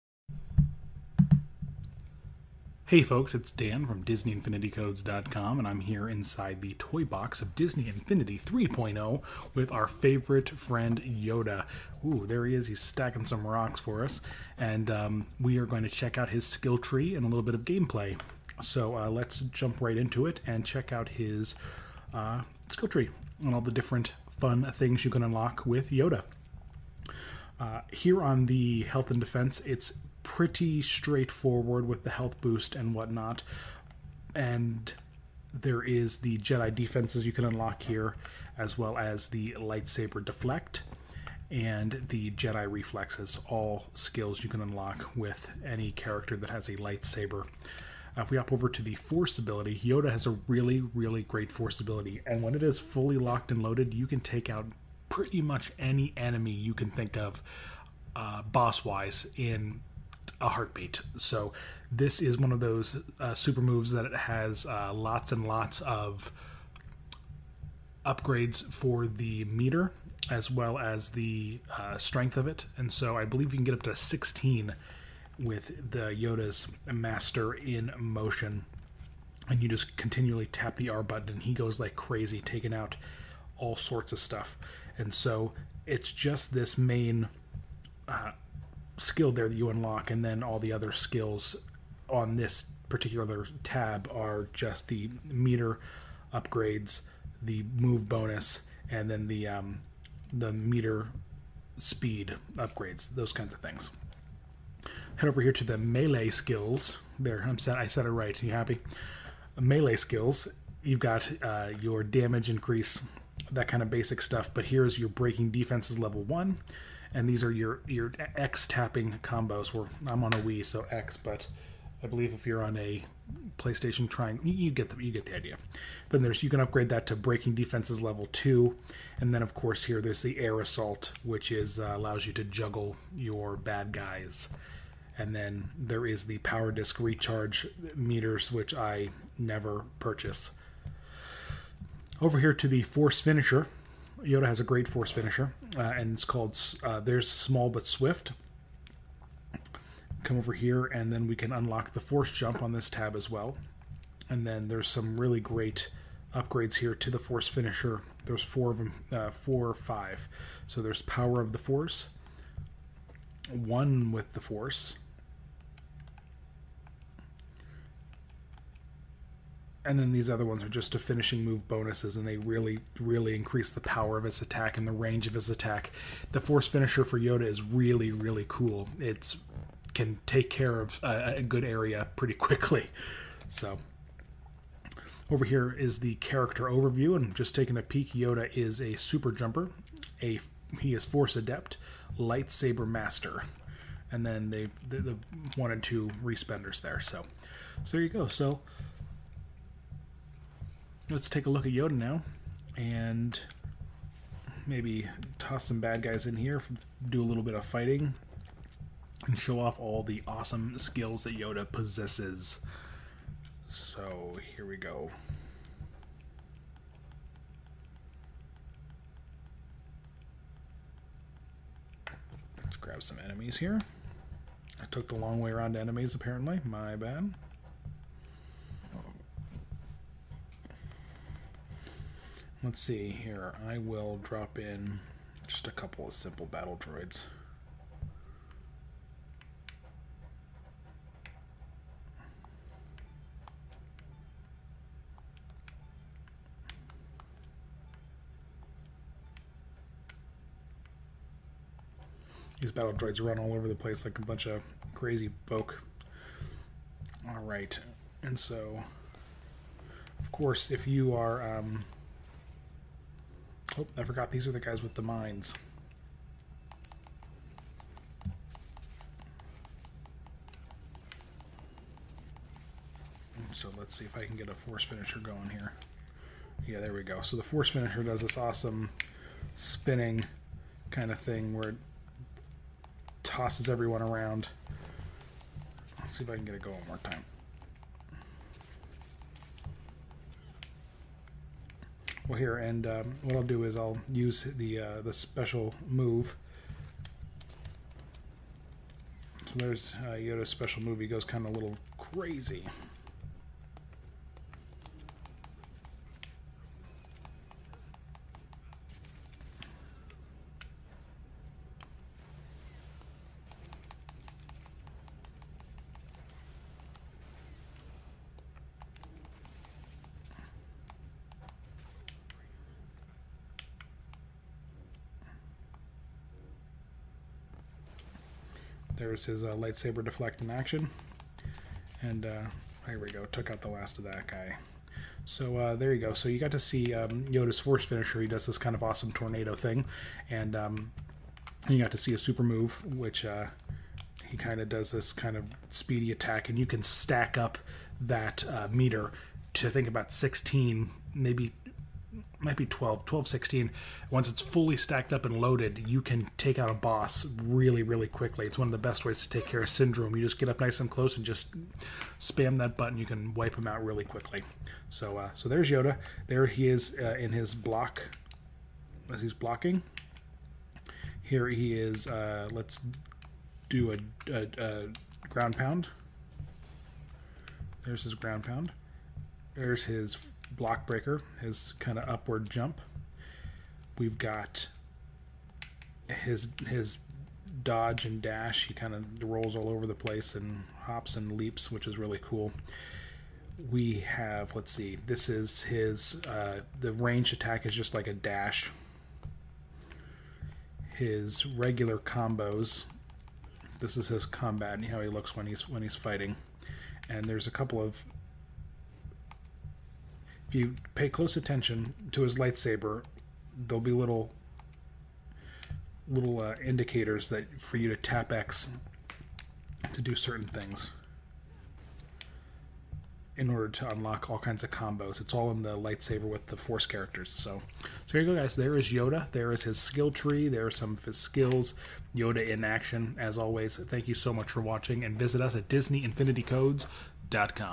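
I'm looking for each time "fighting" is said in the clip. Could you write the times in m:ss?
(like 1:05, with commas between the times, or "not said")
3:27, 6:45.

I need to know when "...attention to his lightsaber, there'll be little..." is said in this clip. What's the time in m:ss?
6:51.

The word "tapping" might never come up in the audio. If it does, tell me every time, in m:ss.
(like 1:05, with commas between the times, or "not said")
1:58.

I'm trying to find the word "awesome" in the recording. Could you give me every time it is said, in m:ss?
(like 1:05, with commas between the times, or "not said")
3:30, 4:38, 5:38.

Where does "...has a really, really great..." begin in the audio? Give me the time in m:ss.
0:50.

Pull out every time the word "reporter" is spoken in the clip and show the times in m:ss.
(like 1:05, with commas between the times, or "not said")
not said.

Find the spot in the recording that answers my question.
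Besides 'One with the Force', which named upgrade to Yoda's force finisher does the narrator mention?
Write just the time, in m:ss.
2:41.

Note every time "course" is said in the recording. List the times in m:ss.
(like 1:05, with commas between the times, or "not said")
2:09, 4:20.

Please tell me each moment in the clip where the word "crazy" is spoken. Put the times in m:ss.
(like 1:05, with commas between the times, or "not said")
1:21, 4:14, 5:01.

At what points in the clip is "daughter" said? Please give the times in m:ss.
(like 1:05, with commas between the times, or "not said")
not said.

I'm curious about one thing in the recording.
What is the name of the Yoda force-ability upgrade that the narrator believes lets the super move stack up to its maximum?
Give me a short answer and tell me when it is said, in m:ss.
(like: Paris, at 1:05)
Yoda's Master in Motion, at 1:16.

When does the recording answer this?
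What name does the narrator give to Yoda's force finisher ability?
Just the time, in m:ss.
2:26.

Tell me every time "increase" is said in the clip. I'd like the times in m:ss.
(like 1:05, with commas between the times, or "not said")
1:52, 2:53.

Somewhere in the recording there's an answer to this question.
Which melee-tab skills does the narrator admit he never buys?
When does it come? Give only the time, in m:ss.
2:16.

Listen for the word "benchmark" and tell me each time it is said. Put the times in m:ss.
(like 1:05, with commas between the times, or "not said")
not said.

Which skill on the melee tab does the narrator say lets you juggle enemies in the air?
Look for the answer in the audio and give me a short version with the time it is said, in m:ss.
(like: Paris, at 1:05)
Air assault, at 2:10.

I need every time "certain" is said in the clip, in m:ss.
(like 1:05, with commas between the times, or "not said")
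7:00.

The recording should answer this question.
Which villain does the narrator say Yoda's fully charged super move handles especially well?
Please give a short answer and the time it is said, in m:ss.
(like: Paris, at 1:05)
Syndrome, at 5:59.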